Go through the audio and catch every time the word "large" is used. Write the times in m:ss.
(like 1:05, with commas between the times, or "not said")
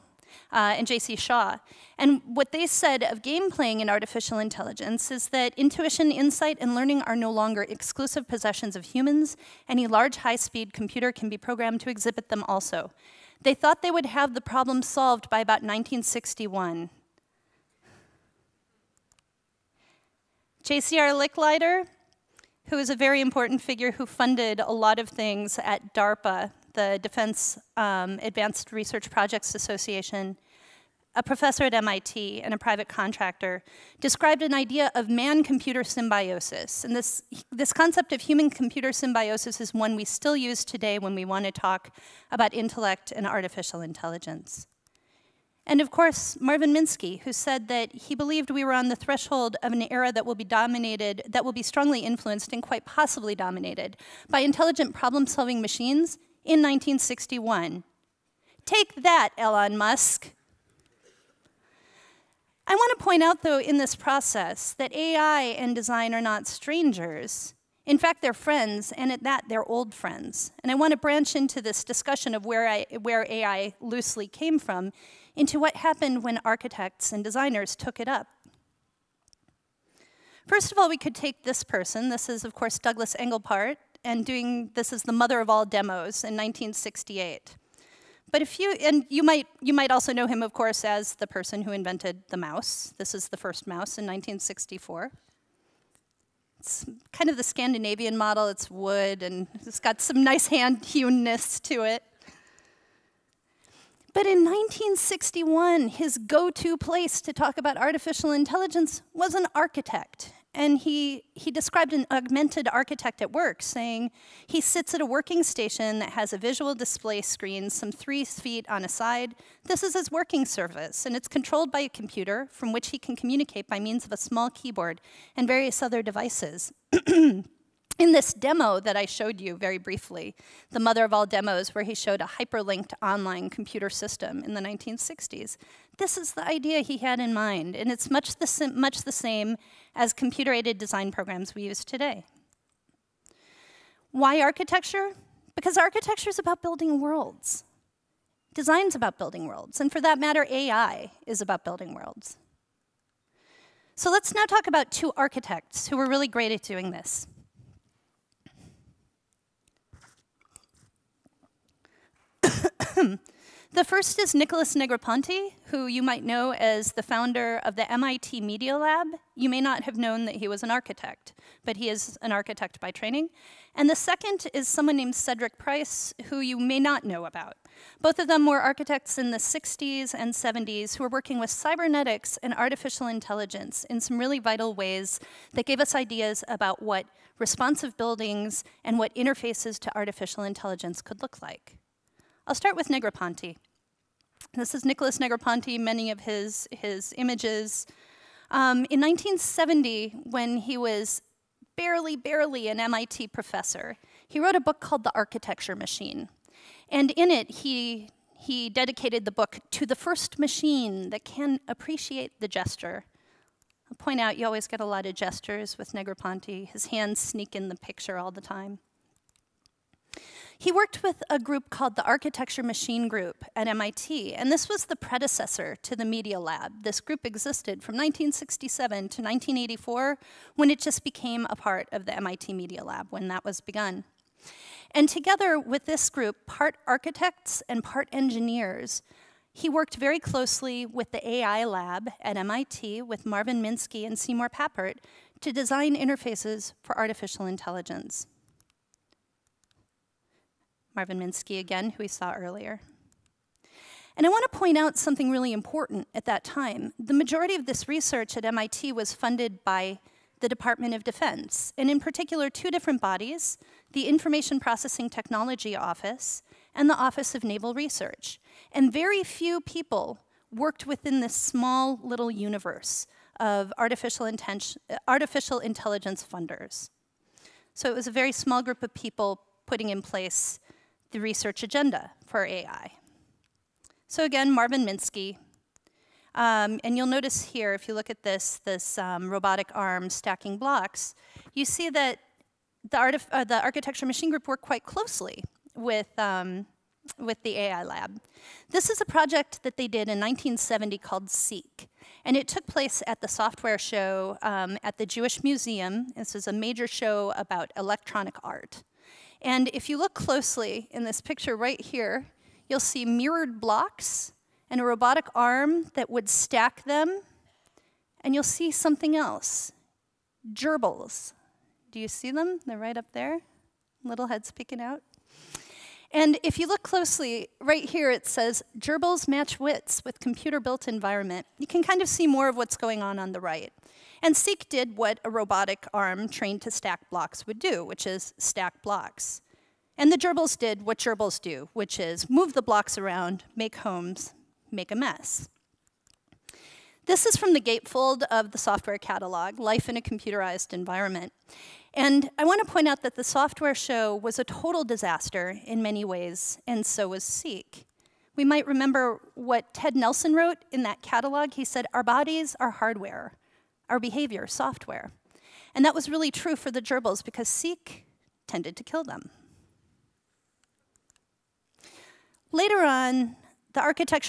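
0:09.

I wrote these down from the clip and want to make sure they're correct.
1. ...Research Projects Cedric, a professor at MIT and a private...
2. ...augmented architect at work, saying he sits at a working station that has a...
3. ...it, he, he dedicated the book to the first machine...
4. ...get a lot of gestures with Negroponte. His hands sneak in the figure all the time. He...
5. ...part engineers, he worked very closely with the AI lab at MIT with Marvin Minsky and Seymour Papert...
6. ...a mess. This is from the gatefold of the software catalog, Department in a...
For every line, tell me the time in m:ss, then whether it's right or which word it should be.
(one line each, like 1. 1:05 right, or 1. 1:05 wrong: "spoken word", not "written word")
1. 0:28 wrong: "Association", not "Cedric"
2. 1:52 right
3. 3:27 right
4. 3:34 wrong: "picture", not "figure"
5. 3:57 right
6. 5:44 wrong: "Life", not "Department".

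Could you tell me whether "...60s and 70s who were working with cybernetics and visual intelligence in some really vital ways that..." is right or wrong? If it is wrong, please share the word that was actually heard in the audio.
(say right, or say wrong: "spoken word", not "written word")
wrong: "artificial", not "visual".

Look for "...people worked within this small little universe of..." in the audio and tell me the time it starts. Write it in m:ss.
4:29.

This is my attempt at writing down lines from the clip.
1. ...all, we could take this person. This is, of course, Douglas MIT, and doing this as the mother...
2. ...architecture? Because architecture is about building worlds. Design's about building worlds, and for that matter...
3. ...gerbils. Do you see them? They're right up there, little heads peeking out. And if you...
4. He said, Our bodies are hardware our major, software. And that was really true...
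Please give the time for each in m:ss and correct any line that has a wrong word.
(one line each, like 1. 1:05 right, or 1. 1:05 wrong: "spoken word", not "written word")
1. 1:20 wrong: "Engelbart", not "MIT"
2. 2:24 right
3. 5:20 right
4. 6:01 wrong: "behavior", not "major".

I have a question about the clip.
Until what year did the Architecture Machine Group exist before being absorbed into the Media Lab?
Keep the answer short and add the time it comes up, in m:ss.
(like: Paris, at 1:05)
1984, at 3:49.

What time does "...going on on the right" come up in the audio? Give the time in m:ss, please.
5:32.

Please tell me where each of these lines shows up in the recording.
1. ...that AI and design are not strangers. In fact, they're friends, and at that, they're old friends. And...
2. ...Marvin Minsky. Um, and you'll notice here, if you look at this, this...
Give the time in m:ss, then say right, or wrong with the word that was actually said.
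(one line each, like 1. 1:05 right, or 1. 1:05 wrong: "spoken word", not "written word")
1. 1:04 right
2. 4:44 right.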